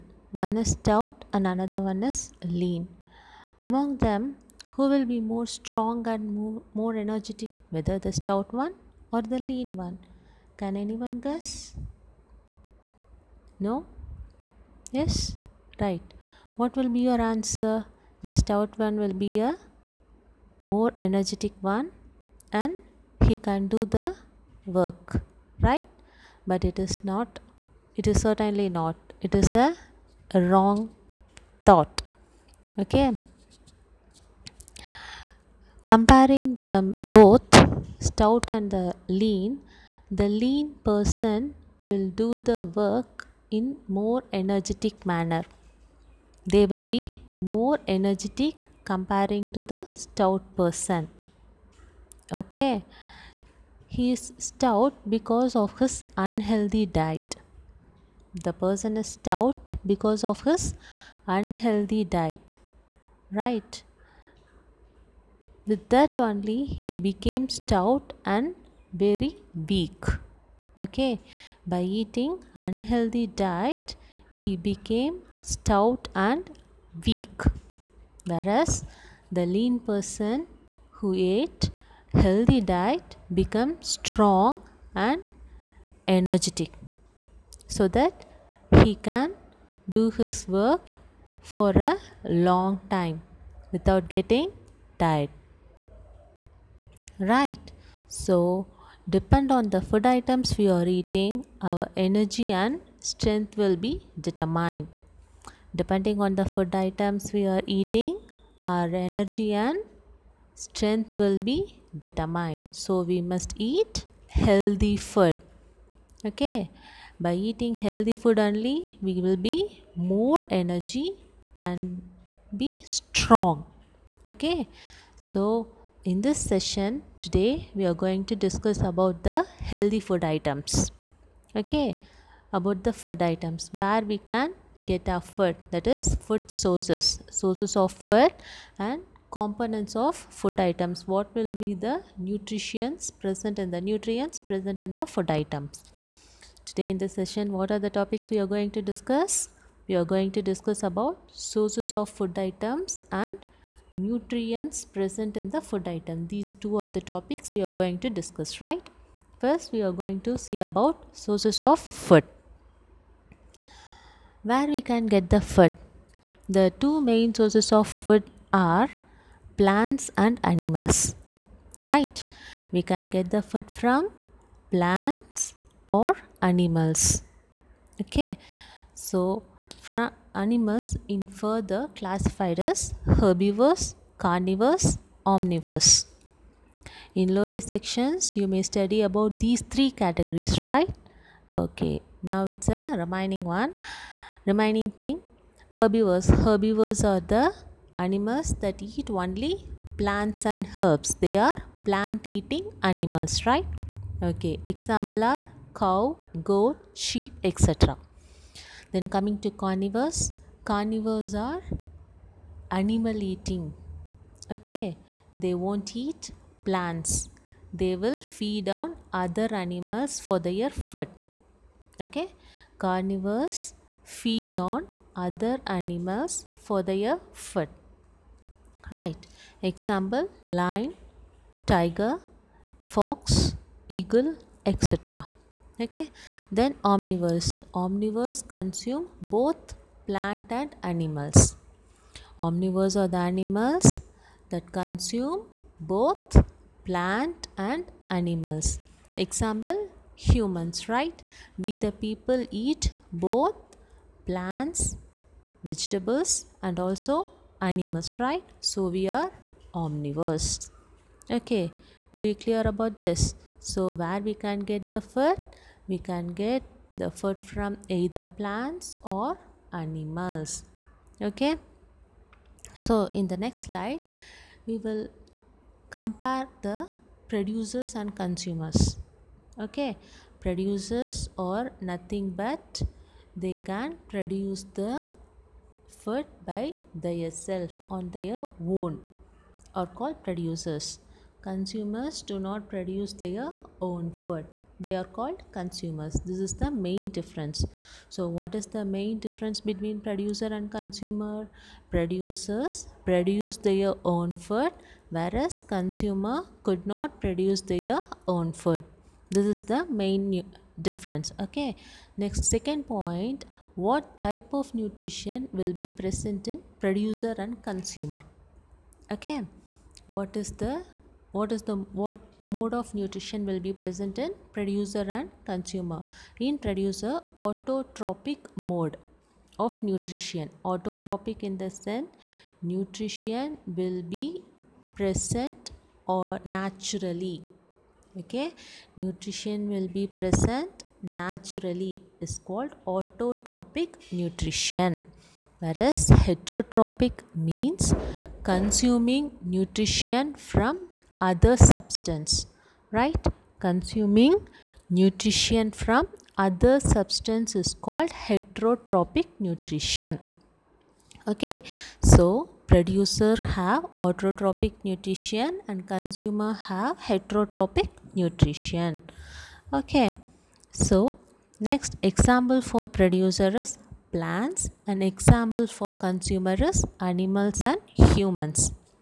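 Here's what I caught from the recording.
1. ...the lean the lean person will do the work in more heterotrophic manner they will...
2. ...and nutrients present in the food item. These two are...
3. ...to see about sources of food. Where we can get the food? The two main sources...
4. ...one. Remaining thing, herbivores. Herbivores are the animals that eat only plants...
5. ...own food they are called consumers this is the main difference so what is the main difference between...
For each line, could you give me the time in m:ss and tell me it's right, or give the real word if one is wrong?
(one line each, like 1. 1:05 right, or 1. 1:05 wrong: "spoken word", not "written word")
1. 0:38 wrong: "energetic", not "heterotrophic"
2. 2:33 right
3. 2:40 right
4. 3:13 right
5. 4:53 right.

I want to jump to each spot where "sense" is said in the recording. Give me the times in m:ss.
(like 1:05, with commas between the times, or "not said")
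5:31.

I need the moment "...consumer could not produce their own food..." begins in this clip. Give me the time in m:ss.
5:05.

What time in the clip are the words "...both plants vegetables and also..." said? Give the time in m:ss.
4:13.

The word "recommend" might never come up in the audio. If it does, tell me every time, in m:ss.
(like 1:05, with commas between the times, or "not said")
not said.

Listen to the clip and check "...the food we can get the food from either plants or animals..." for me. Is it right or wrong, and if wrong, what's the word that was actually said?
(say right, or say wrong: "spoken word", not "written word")
right.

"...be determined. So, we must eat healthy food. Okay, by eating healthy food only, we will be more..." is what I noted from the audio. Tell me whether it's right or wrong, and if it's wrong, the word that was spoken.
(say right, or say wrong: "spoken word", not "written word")
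right.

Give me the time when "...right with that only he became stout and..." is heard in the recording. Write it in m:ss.
1:03.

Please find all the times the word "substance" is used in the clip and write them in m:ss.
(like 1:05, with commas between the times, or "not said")
5:51, 5:56.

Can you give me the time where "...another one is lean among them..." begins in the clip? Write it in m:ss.
0:01.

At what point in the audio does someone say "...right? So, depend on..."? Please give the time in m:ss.
1:37.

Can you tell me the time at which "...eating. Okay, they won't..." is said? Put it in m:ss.
3:33.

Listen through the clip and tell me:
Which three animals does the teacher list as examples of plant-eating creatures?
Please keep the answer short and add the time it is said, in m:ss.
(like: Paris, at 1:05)
Cow, goat, sheep, at 3:25.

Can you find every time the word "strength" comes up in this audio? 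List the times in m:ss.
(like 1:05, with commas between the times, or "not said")
1:43, 1:50.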